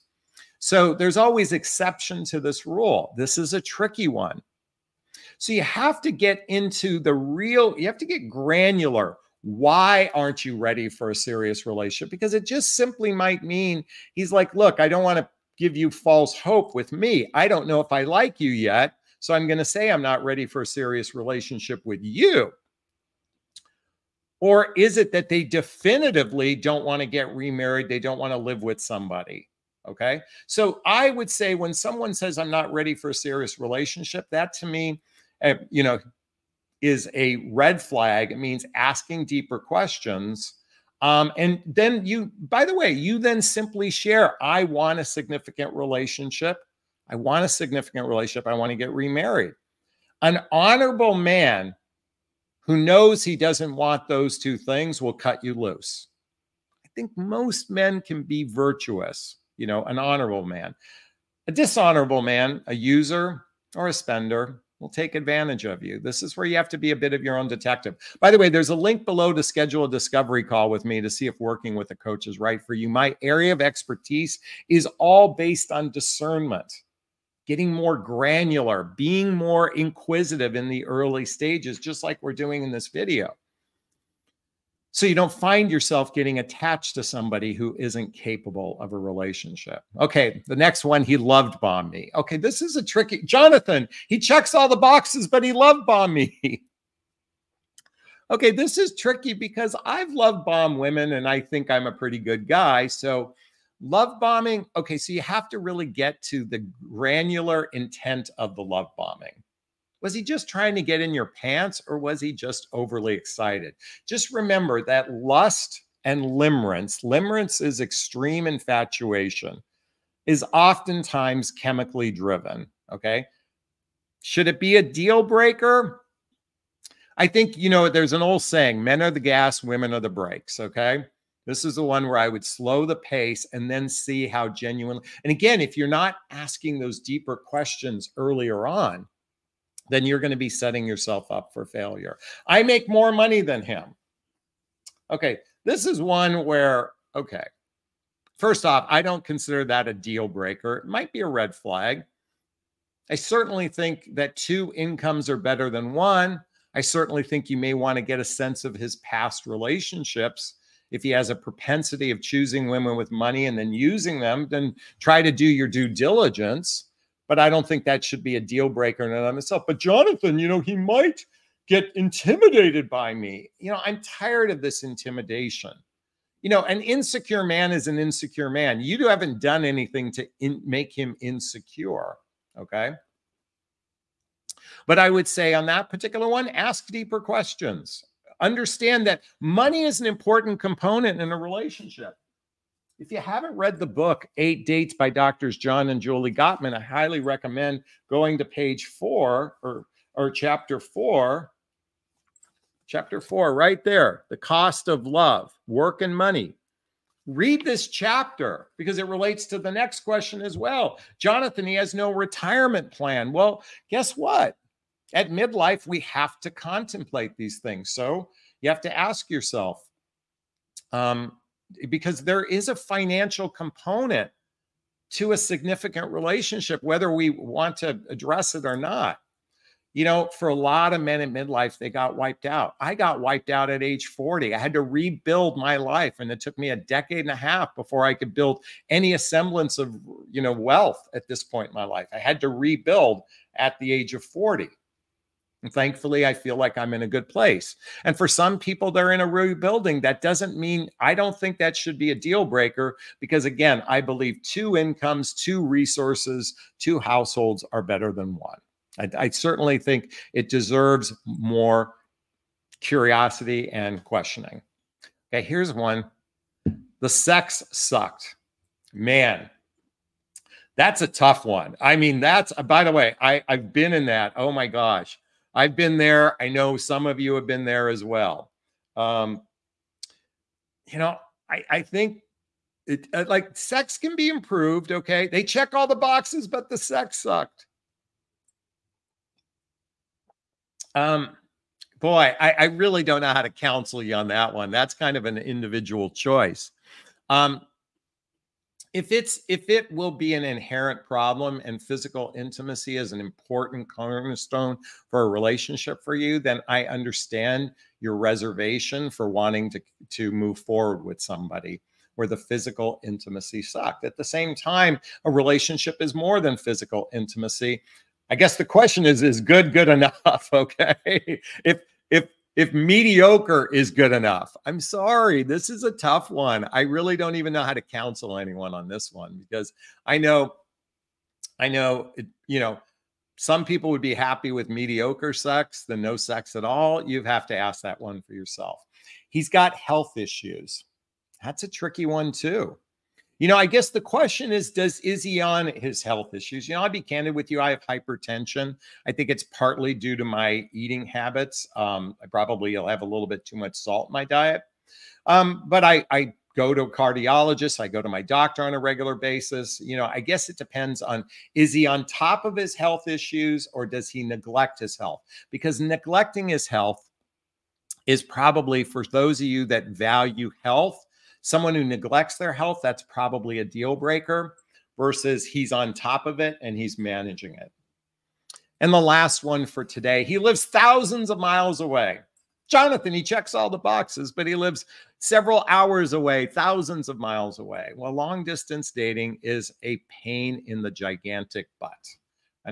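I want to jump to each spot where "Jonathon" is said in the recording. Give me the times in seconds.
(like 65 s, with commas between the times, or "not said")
93 s, 169 s, 211 s, 382 s.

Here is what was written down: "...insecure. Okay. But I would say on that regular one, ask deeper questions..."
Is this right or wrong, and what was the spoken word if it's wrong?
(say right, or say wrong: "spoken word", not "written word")
wrong: "particular", not "regular".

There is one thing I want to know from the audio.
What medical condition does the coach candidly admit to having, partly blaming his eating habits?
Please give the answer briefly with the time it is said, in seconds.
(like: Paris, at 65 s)
hypertension, at 347 s.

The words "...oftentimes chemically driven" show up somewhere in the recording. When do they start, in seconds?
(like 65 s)
120 s.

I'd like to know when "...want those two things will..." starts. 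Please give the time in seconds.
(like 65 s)
53 s.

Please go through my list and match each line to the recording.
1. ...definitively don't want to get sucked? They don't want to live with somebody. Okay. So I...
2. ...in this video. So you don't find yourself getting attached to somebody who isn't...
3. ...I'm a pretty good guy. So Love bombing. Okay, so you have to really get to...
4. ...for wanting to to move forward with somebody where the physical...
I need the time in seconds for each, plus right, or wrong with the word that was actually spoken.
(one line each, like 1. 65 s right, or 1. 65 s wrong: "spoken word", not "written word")
1. 25 s wrong: "remarried", not "sucked"
2. 82 s right
3. 101 s right
4. 309 s right.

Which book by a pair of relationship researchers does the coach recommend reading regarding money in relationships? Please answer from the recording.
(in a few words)
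Eight Dates.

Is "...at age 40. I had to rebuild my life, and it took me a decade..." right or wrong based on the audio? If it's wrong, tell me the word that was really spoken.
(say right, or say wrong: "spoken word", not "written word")
right.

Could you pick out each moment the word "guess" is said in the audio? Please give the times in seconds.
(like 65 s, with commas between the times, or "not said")
213 s, 318 s, 343 s, 360 s.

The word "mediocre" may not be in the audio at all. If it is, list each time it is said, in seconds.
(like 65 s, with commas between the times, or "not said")
322 s, 334 s.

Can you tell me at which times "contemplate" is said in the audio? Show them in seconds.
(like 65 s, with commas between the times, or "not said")
216 s.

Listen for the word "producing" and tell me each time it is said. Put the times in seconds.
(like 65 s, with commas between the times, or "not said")
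not said.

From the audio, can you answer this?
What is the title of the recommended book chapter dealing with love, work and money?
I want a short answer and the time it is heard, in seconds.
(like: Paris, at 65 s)
The Cost of Love, at 204 s.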